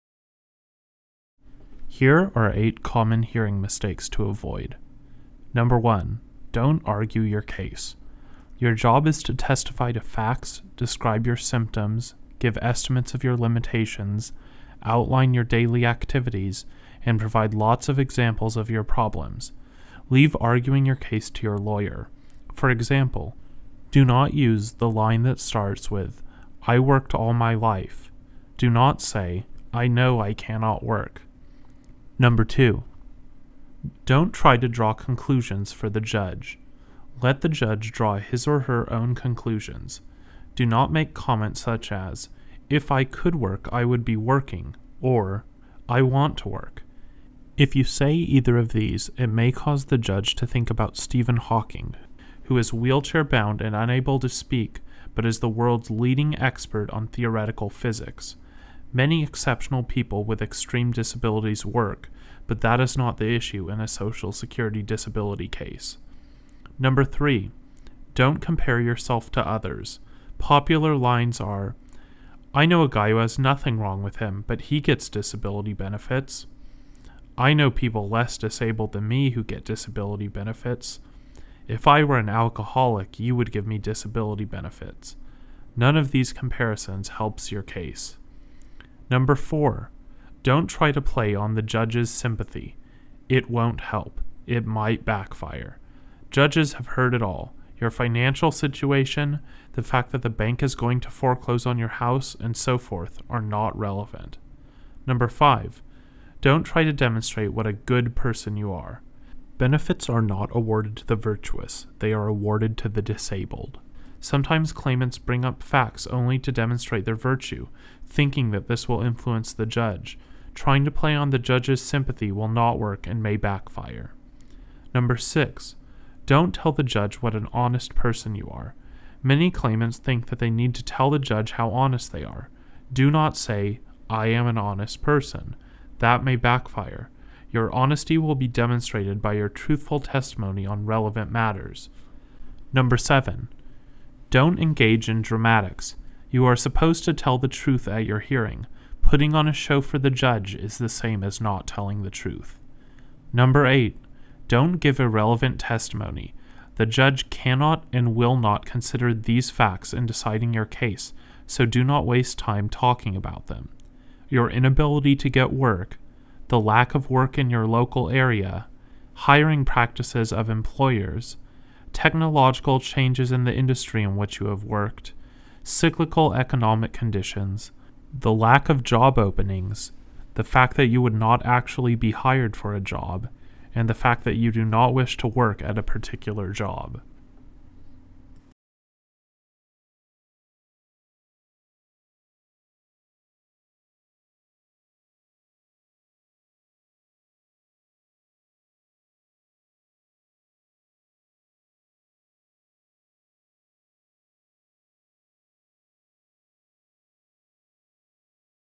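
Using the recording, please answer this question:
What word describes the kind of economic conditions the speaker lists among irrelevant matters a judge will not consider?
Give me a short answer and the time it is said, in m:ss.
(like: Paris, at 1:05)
cyclical, at 2:55.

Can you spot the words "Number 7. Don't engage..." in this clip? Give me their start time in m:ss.
2:22.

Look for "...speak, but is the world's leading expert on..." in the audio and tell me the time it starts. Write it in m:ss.
0:54.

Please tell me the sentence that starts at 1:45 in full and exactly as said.
Number five, don't try to demonstrate what a good person you are.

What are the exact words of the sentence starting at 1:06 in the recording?
Number three, don't compare yourself to others.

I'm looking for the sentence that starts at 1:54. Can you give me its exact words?
Sometimes claimants bring up facts only to demonstrate their virtue, thinking that this will influence the judge.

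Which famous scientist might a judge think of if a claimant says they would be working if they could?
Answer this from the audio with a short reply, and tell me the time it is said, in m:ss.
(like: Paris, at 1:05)
Stephen Hawking, at 0:50.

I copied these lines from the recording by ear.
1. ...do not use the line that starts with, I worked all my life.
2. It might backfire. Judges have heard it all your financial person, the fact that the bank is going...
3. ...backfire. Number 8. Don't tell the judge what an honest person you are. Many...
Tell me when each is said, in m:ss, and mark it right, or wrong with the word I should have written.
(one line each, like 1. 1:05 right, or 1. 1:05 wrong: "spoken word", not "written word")
1. 0:23 right
2. 1:34 wrong: "situation", not "person"
3. 2:03 wrong: "6", not "8".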